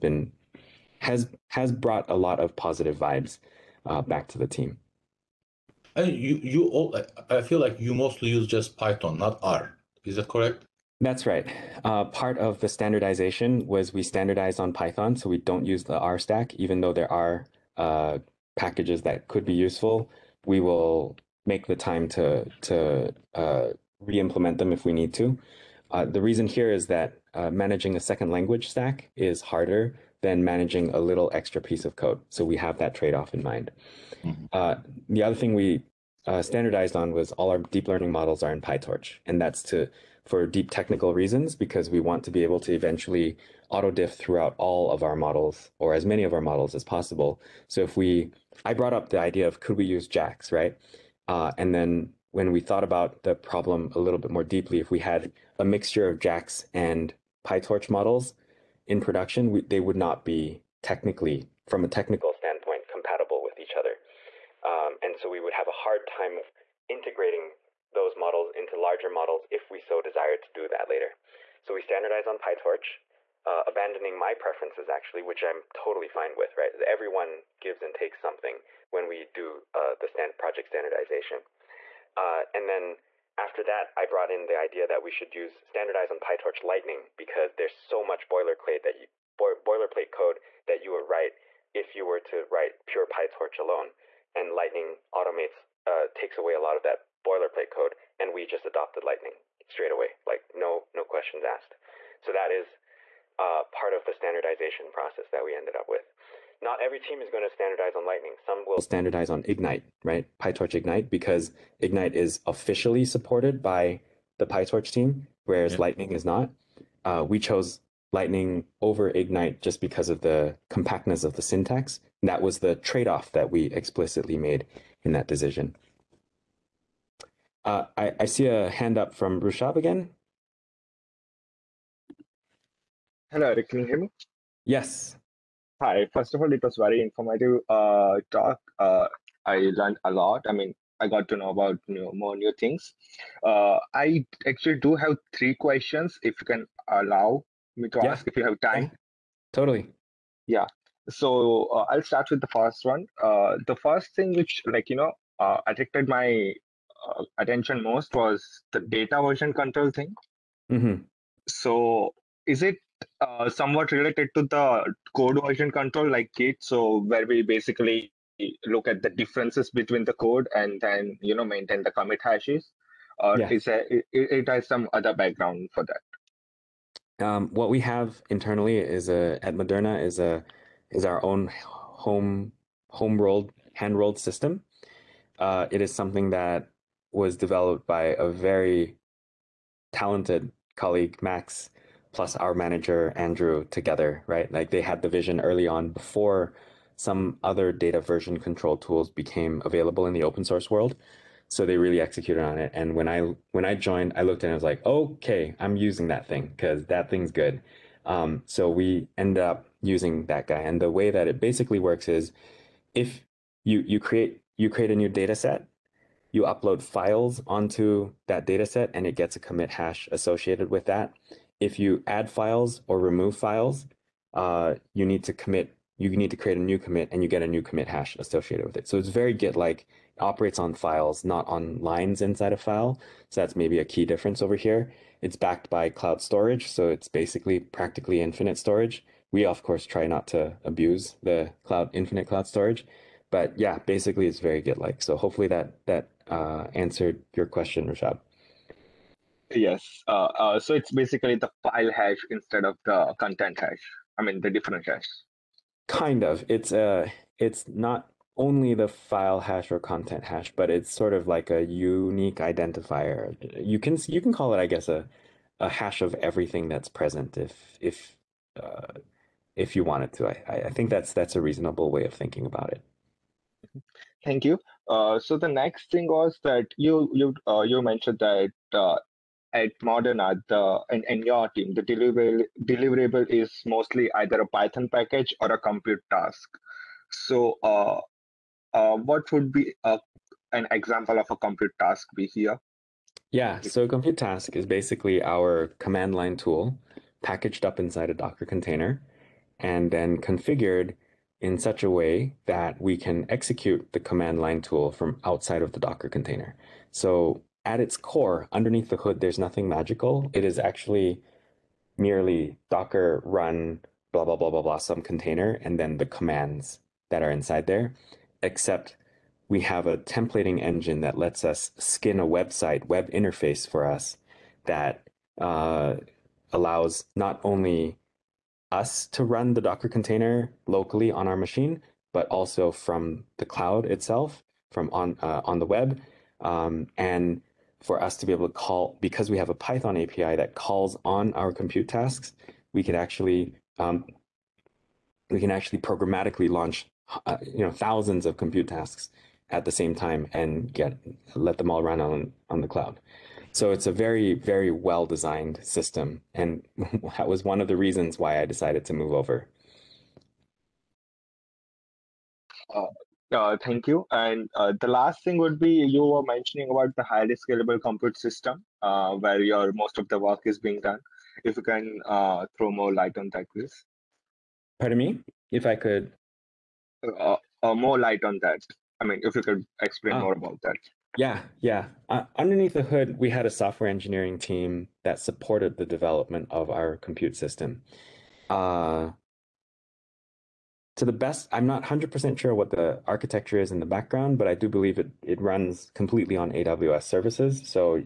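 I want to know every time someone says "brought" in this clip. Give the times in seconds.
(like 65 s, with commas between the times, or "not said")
1 s, 48 s, 84 s.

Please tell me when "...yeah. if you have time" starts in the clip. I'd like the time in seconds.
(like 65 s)
148 s.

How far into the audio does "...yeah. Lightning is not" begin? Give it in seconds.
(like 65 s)
115 s.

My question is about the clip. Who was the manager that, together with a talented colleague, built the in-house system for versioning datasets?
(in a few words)
Andrew.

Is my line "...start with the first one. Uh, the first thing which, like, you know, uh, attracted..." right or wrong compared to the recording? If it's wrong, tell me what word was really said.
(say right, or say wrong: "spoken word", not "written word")
right.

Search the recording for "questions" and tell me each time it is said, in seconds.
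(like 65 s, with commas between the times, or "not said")
101 s, 145 s, 247 s.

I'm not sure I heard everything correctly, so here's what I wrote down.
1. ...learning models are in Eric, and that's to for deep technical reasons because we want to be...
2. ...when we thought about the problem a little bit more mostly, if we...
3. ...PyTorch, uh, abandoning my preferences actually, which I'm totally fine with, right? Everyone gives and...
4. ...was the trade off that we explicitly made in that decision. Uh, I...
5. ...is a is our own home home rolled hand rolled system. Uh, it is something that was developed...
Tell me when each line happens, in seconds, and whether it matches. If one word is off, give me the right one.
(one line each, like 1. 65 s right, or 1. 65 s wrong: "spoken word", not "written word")
1. 37 s wrong: "PyTorch", not "Eric"
2. 52 s wrong: "deeply", not "mostly"
3. 72 s right
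4. 122 s right
5. 180 s right.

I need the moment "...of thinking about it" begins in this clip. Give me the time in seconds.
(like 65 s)
272 s.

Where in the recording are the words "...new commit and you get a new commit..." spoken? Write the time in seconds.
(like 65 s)
226 s.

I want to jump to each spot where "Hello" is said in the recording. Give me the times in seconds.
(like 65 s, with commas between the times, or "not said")
133 s.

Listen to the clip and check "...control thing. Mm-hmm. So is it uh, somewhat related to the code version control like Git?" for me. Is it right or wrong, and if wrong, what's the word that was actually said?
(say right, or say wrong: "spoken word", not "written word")
right.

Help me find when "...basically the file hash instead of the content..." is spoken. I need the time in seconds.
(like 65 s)
250 s.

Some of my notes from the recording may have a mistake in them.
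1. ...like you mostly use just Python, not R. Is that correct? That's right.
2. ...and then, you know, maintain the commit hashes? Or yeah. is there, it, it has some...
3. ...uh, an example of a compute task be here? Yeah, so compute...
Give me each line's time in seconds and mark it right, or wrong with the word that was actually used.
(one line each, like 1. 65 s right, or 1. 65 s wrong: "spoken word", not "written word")
1. 7 s right
2. 170 s right
3. 289 s right.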